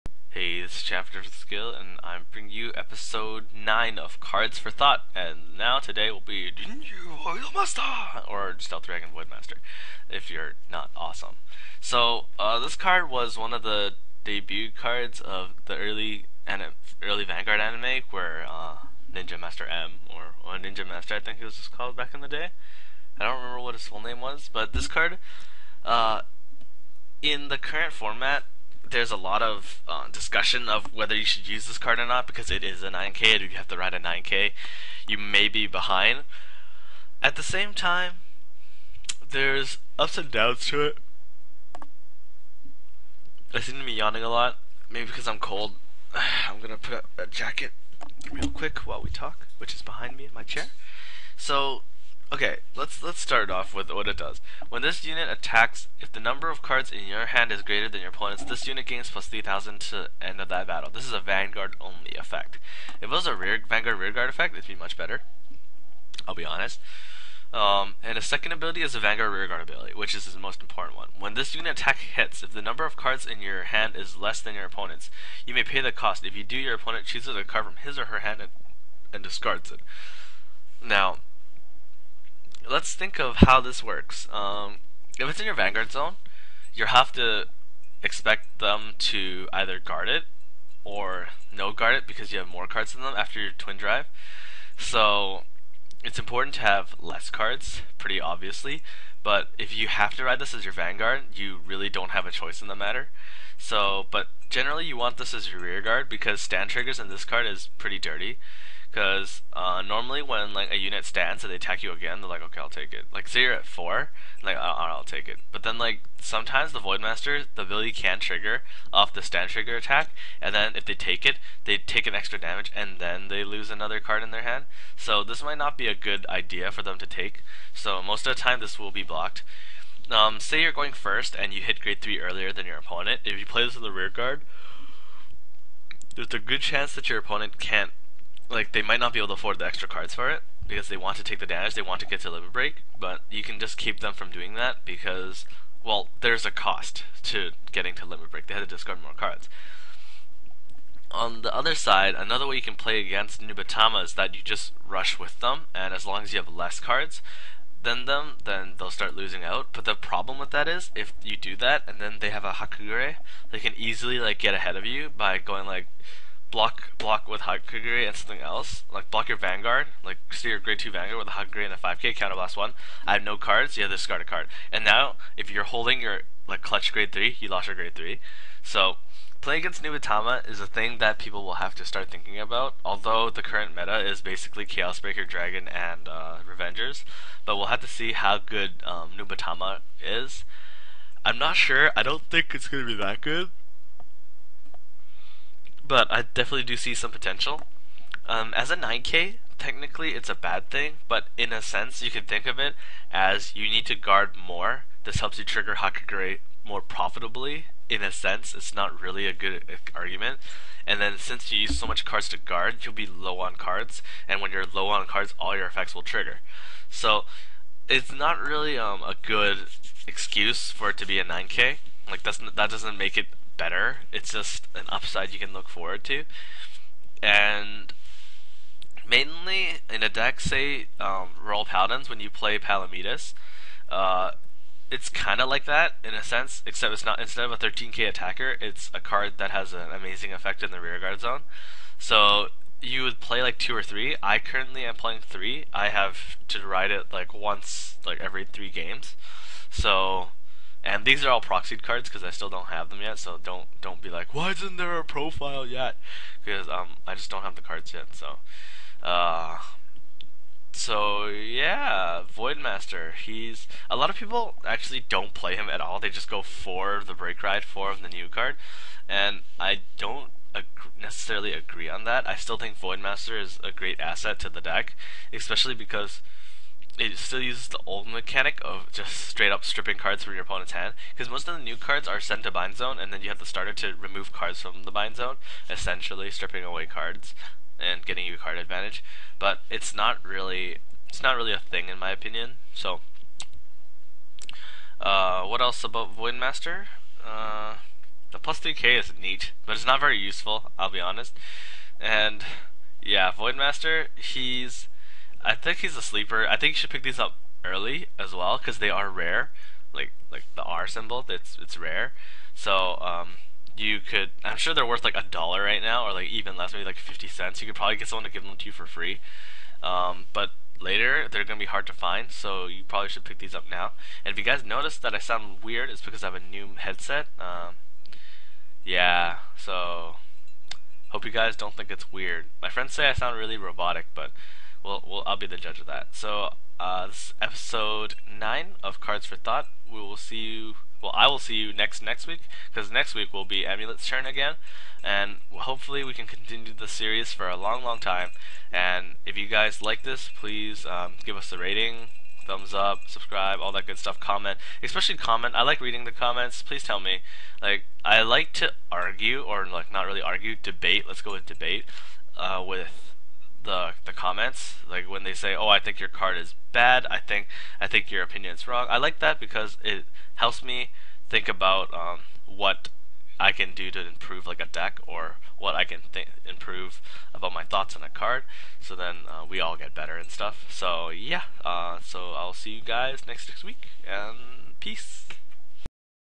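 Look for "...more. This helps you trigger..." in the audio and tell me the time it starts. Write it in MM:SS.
03:24.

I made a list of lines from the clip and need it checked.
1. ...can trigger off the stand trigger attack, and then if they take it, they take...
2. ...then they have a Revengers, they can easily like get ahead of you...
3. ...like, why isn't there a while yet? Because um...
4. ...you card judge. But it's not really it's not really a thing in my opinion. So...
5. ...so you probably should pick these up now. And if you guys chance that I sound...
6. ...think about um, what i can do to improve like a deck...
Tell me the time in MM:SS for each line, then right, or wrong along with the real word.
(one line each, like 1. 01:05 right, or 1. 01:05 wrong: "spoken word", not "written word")
1. 01:57 right
2. 02:41 wrong: "Hakugure", not "Revengers"
3. 04:14 wrong: "profile", not "while"
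4. 04:48 wrong: "advantage", not "judge"
5. 05:22 wrong: "notice", not "chance"
6. 06:11 right.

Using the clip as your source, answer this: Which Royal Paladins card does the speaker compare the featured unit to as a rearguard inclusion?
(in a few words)
Palamedes.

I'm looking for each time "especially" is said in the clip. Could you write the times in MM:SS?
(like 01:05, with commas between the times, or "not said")
04:35, 05:54.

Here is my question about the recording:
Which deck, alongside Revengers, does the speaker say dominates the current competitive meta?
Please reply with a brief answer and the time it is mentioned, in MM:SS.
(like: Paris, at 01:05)
Chaos Breaker Dragon, at 03:04.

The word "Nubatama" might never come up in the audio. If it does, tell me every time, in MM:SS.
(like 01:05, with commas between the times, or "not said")
02:33, 02:59, 03:09.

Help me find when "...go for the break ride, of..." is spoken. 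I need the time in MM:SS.
04:26.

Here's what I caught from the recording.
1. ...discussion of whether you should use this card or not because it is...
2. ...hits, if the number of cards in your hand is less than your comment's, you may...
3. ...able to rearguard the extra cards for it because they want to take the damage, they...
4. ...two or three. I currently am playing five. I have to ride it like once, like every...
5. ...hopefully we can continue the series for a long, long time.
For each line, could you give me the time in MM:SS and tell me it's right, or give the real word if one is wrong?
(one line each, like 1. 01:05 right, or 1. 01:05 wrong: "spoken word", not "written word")
1. 00:30 right
2. 01:11 wrong: "opponent", not "comment"
3. 02:19 wrong: "afford", not "rearguard"
4. 04:03 wrong: "three", not "five"
5. 05:45 right.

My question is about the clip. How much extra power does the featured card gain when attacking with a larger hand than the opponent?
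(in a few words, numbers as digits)
3,000.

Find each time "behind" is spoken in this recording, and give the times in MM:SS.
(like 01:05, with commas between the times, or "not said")
00:35, 00:49.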